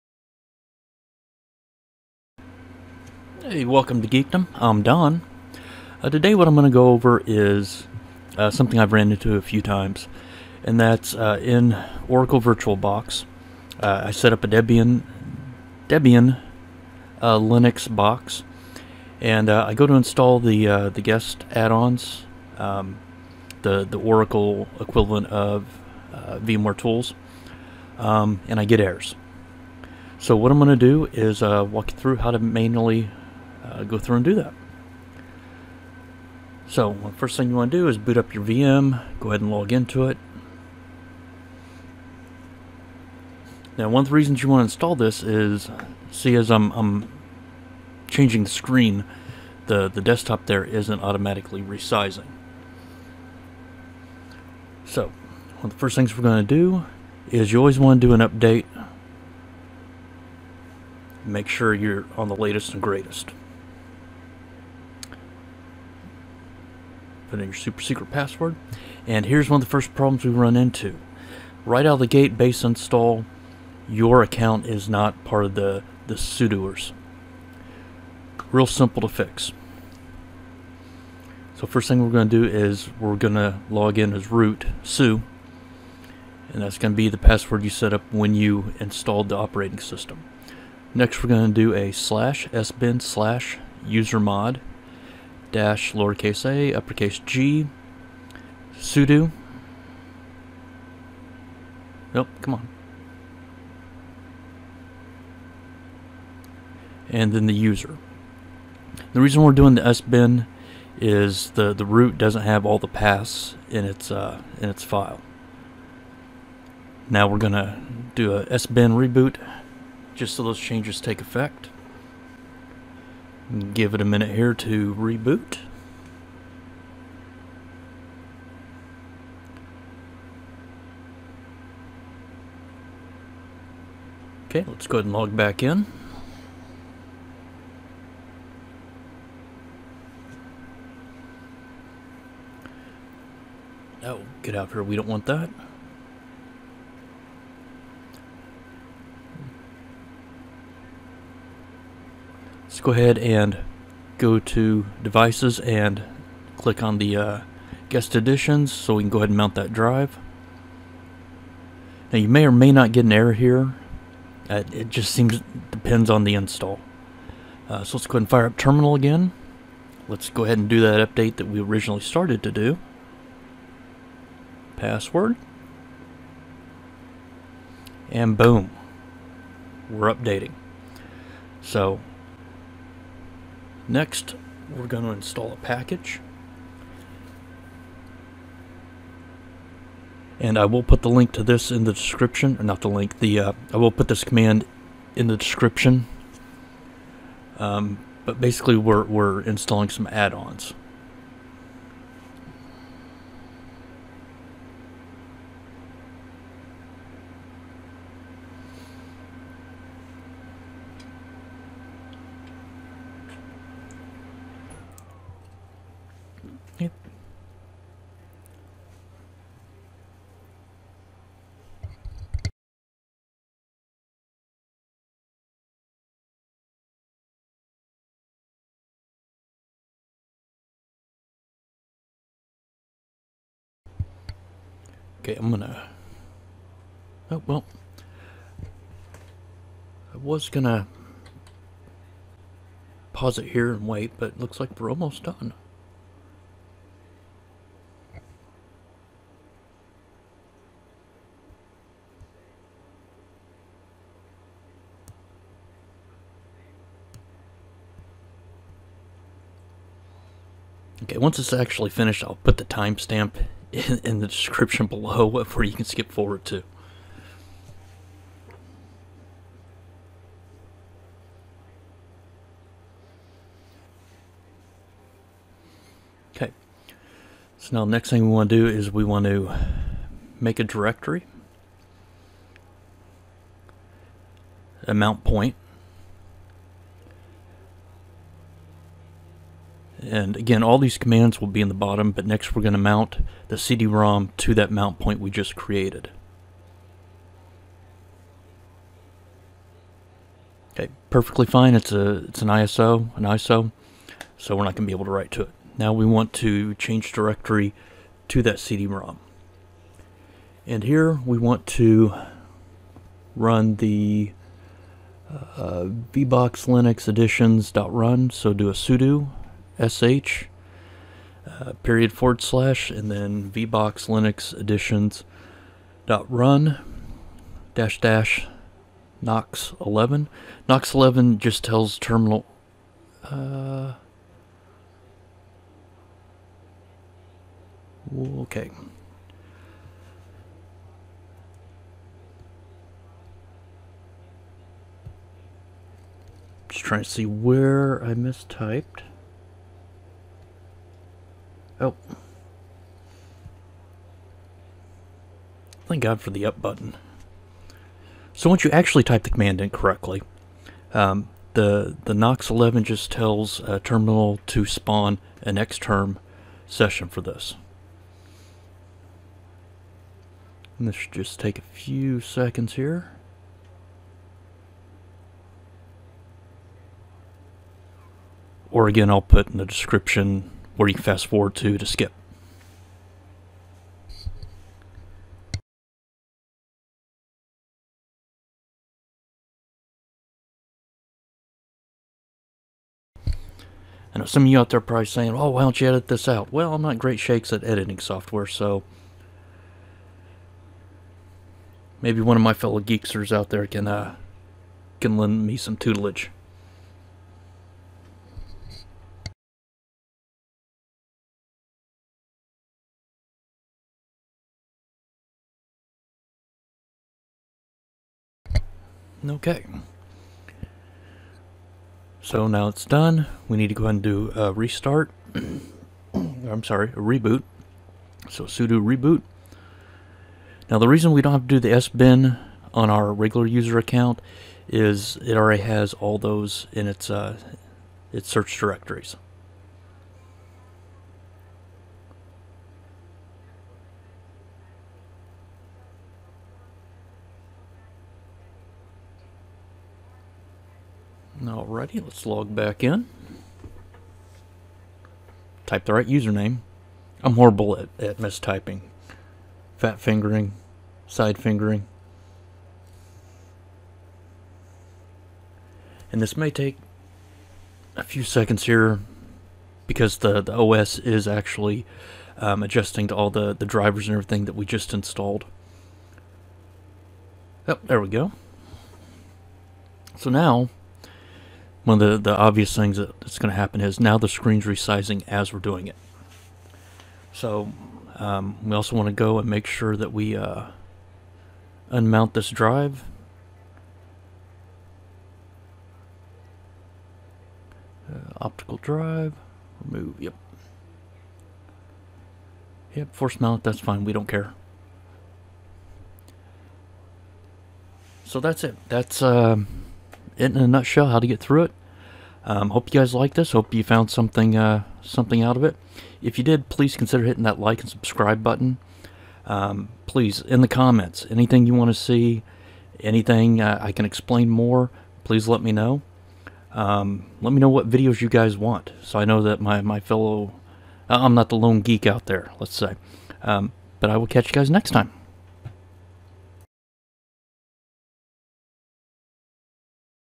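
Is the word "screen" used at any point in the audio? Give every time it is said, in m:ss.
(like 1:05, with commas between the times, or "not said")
0:48, 8:04.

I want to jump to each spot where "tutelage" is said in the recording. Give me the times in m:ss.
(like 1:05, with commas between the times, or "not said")
6:45.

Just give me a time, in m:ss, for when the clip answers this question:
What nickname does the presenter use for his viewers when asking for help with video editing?
6:42.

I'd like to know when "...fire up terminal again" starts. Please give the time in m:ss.
2:48.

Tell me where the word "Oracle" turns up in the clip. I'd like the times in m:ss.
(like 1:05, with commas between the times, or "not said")
0:12, 0:23.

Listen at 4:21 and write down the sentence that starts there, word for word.
Okay, once it's actually finished, I'll put the timestamp in, in the description below where you can skip forward to.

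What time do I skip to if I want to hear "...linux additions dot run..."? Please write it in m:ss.
5:24.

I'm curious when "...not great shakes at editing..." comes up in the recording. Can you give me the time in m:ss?
6:36.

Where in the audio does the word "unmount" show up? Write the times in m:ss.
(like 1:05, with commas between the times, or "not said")
8:11.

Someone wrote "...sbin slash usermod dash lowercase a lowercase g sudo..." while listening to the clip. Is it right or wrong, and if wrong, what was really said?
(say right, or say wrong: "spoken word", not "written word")
wrong: "uppercase", not "lowercase".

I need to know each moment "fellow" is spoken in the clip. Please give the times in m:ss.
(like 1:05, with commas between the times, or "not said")
6:42, 8:49.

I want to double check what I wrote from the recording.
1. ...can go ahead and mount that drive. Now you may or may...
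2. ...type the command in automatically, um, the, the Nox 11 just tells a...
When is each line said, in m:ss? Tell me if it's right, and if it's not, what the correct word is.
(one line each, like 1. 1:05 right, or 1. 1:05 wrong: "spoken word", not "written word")
1. 2:39 right
2. 5:59 wrong: "correctly", not "automatically".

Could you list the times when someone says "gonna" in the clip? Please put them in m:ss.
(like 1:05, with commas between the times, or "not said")
1:57, 3:55, 4:00.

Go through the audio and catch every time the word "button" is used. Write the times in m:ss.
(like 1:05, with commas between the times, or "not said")
5:56, 8:38.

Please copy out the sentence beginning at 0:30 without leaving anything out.
So what I'm going to do is walk you through how to manually uh, go through and do that.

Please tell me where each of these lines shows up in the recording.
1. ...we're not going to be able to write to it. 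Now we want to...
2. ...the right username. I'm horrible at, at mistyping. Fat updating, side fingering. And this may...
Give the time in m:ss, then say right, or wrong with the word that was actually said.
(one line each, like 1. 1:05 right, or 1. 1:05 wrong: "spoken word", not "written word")
1. 5:04 right
2. 7:35 wrong: "fingering", not "updating".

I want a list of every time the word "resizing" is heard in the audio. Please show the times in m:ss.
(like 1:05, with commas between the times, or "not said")
0:51, 8:04.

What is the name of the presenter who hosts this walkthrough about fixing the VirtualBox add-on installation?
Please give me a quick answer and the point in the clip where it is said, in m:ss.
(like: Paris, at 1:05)
Don, at 0:04.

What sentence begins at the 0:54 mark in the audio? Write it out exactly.
So, one of the first things we're going to do is you always want to do an update.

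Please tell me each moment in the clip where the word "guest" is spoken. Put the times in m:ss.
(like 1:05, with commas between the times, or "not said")
0:21, 2:37.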